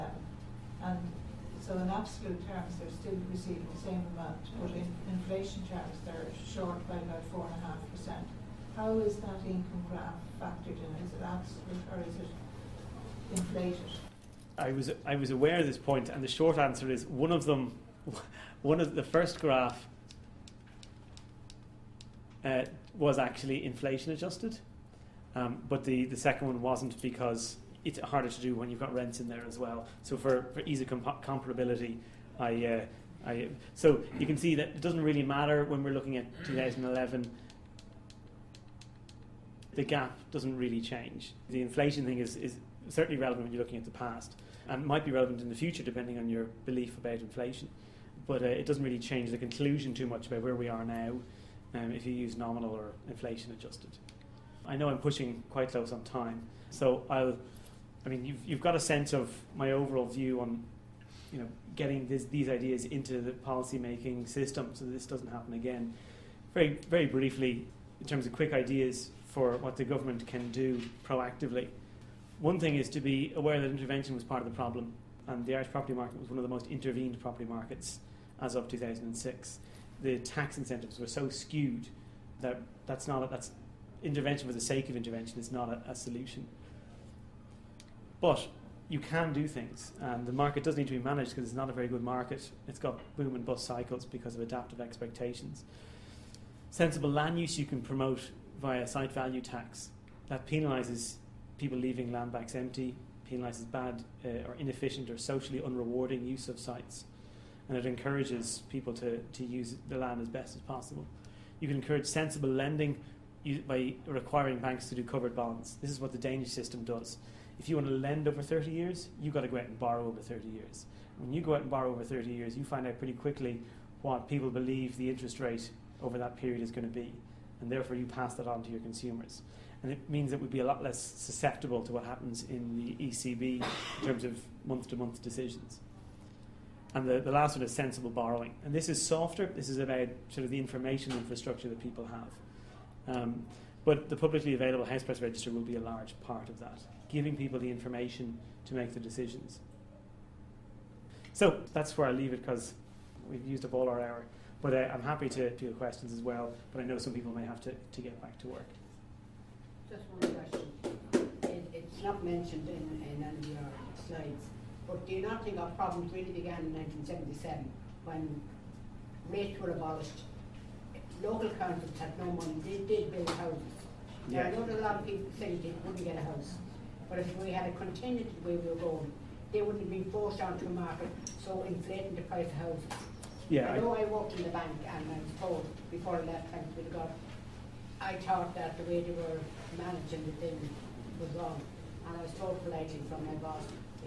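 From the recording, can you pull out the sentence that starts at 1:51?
You can encourage sensible lending by requiring banks to do covered bonds.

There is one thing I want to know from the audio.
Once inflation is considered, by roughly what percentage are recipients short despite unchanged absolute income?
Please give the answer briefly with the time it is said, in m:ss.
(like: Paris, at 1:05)
4.5%, at 0:07.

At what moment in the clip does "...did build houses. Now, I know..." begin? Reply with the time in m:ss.
2:52.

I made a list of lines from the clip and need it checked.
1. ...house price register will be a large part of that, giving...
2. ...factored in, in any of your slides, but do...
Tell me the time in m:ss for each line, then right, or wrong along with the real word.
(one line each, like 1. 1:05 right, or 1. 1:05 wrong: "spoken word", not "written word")
1. 2:24 right
2. 2:42 wrong: "mentioned", not "factored".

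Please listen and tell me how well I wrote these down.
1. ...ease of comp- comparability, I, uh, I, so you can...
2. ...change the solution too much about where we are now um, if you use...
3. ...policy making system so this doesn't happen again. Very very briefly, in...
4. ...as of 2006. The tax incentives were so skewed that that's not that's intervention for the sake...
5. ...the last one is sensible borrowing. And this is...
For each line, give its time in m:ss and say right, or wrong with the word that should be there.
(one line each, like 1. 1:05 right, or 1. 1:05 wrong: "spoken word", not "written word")
1. 0:30 right
2. 0:48 wrong: "conclusion", not "solution"
3. 1:03 right
4. 1:18 right
5. 2:17 right.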